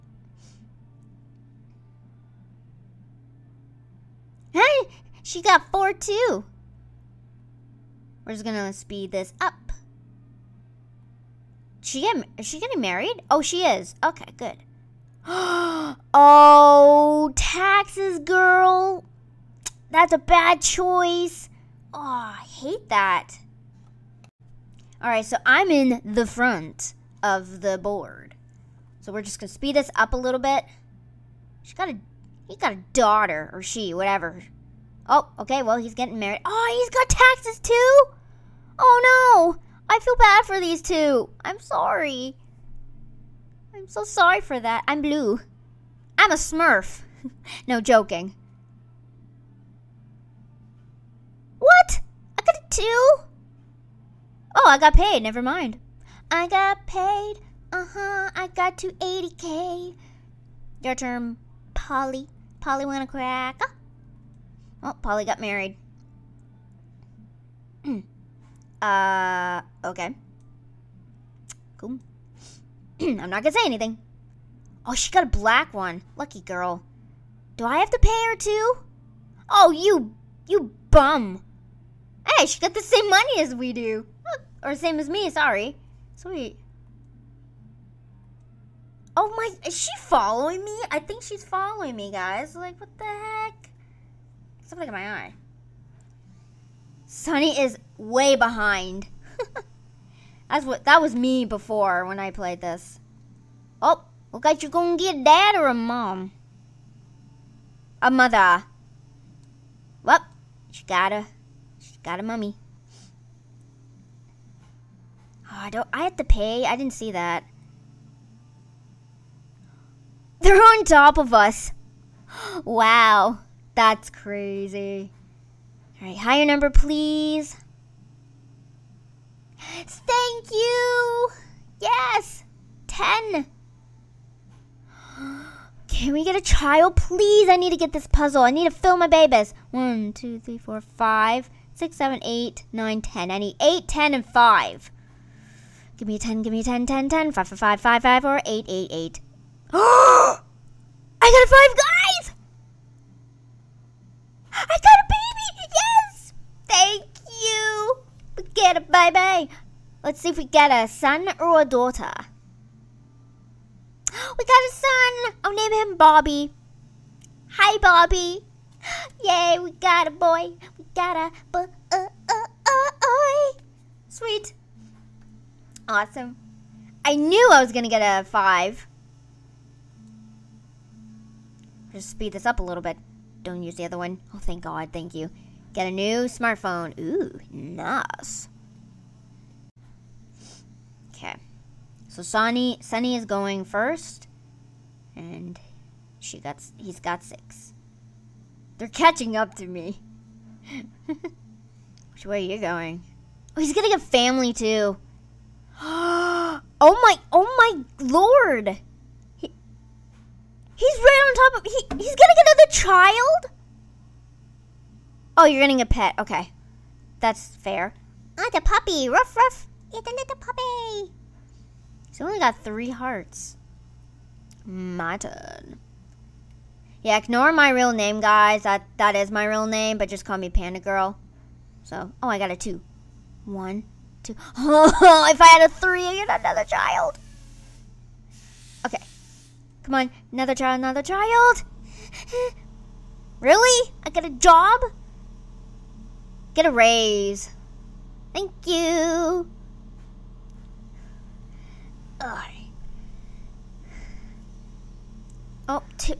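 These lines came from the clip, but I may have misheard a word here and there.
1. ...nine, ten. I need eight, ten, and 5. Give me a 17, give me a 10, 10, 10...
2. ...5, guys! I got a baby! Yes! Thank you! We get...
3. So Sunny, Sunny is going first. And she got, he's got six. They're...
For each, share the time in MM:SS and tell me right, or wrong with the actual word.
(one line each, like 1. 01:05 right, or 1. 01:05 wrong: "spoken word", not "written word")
1. 02:22 wrong: "10", not "17"
2. 02:31 right
3. 03:12 right.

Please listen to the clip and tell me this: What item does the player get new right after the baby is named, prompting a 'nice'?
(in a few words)
smartphone.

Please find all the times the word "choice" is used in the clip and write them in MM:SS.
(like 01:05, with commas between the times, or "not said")
00:20.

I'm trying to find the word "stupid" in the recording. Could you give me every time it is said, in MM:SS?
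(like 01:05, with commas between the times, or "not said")
not said.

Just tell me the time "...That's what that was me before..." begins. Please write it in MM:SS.
01:40.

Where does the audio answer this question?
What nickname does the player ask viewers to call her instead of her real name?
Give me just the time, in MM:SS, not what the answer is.
03:50.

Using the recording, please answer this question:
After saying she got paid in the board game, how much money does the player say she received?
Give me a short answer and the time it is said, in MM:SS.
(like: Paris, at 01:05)
280k, at 00:58.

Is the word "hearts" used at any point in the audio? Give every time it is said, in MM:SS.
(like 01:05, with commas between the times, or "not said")
03:42.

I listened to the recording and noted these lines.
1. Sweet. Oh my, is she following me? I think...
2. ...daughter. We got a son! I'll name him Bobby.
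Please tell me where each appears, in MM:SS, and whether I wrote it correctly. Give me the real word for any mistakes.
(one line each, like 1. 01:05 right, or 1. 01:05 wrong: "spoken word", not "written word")
1. 01:26 right
2. 02:41 right.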